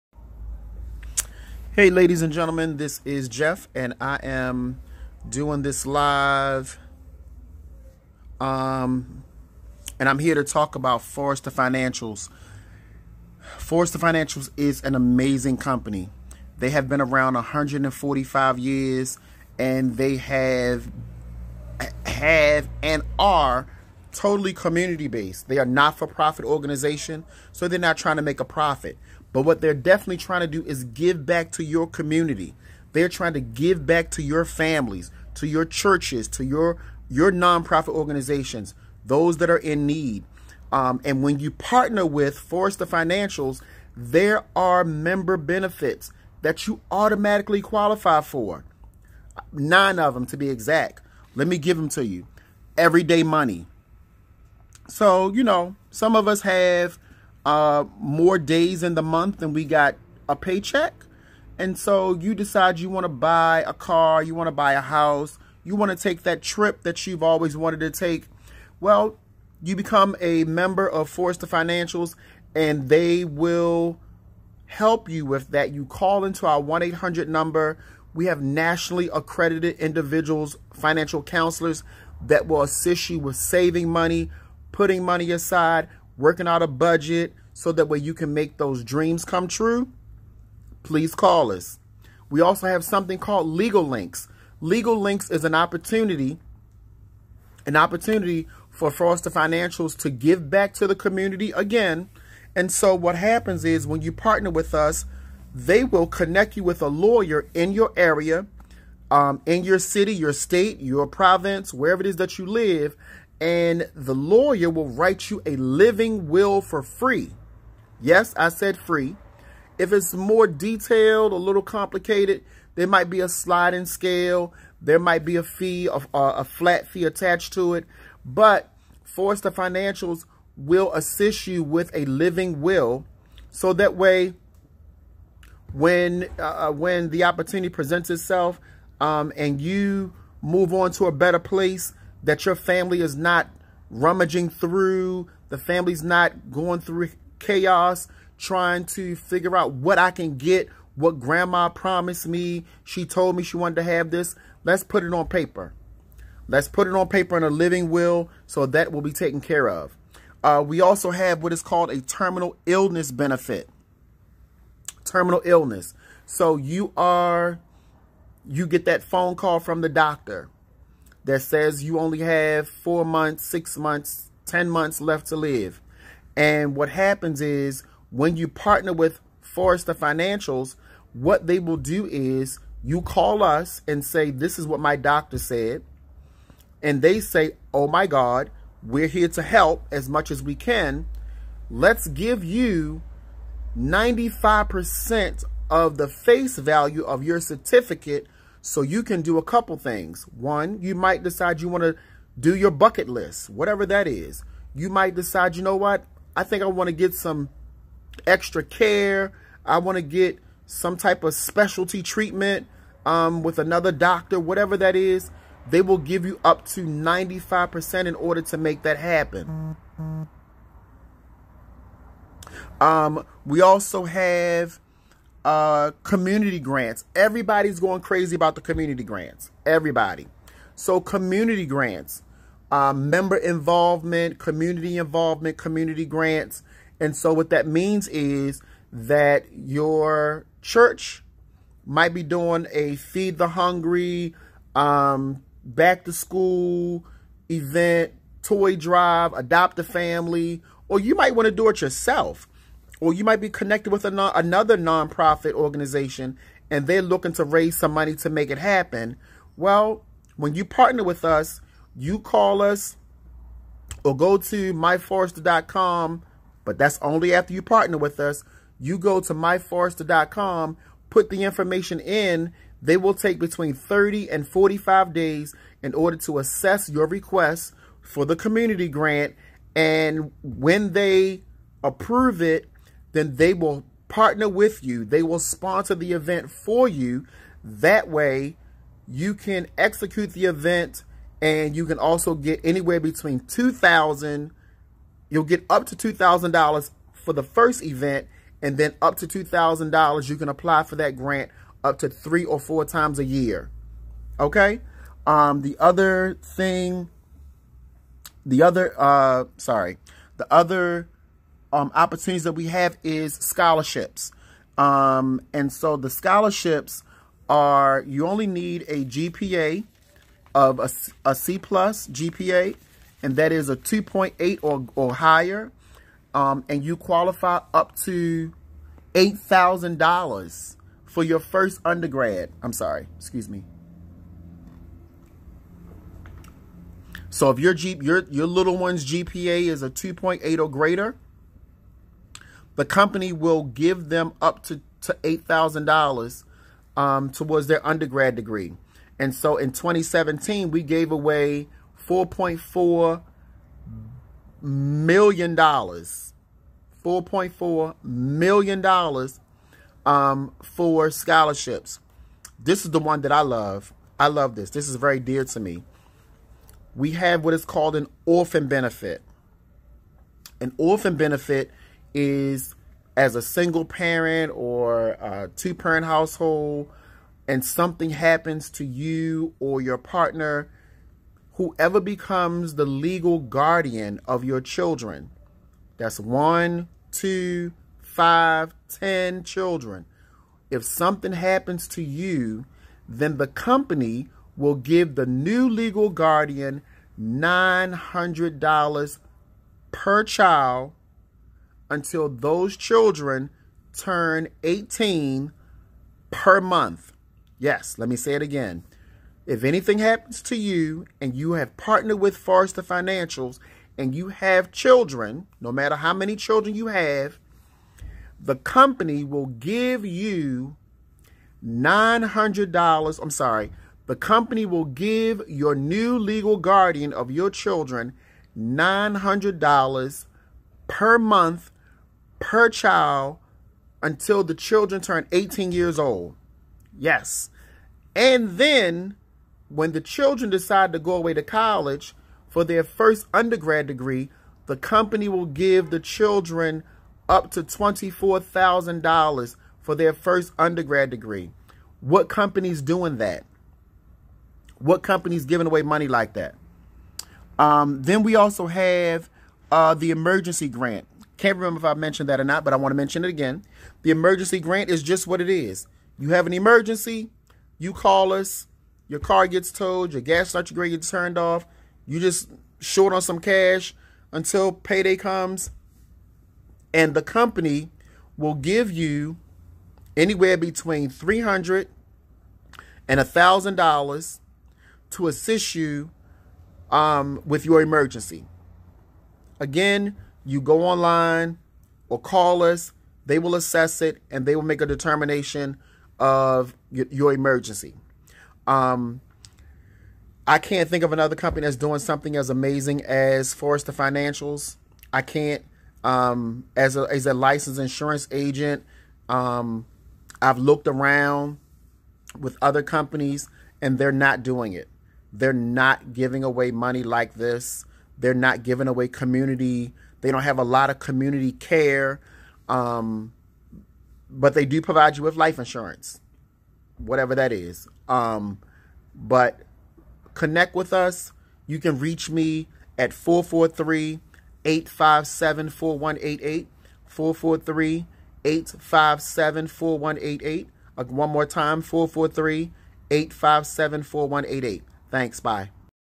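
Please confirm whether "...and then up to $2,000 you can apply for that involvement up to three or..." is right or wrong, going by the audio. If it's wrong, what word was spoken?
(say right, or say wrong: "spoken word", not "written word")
wrong: "grant", not "involvement".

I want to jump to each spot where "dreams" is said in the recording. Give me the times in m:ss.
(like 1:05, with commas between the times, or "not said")
1:28.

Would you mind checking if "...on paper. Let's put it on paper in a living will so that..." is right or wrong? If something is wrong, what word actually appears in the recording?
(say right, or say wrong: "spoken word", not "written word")
right.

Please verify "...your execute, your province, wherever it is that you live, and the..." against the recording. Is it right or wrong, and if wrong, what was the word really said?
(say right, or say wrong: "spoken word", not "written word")
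wrong: "state", not "execute".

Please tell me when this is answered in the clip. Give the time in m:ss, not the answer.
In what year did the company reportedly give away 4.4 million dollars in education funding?
5:49.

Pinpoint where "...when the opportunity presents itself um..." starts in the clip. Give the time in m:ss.
2:16.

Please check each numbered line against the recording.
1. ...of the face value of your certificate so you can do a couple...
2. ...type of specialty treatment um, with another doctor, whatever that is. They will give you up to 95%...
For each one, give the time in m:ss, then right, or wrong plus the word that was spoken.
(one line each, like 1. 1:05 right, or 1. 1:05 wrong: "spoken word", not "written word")
1. 3:15 right
2. 3:30 right.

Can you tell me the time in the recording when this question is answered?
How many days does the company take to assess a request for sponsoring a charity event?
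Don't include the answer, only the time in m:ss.
4:33.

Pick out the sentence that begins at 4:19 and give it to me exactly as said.
Well, when you partner with us, you call us or go to myforesters.com, but that's only after you partner with us.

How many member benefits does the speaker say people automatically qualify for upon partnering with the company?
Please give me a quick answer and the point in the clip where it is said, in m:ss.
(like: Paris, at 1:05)
9, at 0:49.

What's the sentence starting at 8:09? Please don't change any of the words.
Again, you go online or call us.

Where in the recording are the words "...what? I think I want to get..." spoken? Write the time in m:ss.
3:25.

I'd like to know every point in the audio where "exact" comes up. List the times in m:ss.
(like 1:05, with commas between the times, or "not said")
0:50.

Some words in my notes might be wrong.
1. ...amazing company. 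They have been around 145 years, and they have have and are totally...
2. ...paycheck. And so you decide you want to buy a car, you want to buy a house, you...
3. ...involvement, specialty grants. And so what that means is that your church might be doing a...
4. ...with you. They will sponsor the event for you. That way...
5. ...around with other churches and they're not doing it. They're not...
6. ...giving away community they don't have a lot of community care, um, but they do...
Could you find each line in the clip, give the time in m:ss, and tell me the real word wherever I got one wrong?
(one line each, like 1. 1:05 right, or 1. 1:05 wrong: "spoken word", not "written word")
1. 0:14 right
2. 1:00 right
3. 3:54 wrong: "community", not "specialty"
4. 4:44 right
5. 8:30 wrong: "companies", not "churches"
6. 8:38 right.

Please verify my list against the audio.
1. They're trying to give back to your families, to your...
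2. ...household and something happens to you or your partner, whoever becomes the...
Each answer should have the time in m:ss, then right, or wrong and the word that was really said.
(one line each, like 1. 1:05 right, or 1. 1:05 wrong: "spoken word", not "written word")
1. 0:32 right
2. 6:16 right.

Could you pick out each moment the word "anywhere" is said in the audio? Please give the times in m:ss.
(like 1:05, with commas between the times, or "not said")
4:52, 8:00.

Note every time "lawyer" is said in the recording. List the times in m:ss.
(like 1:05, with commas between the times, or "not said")
1:46, 1:54.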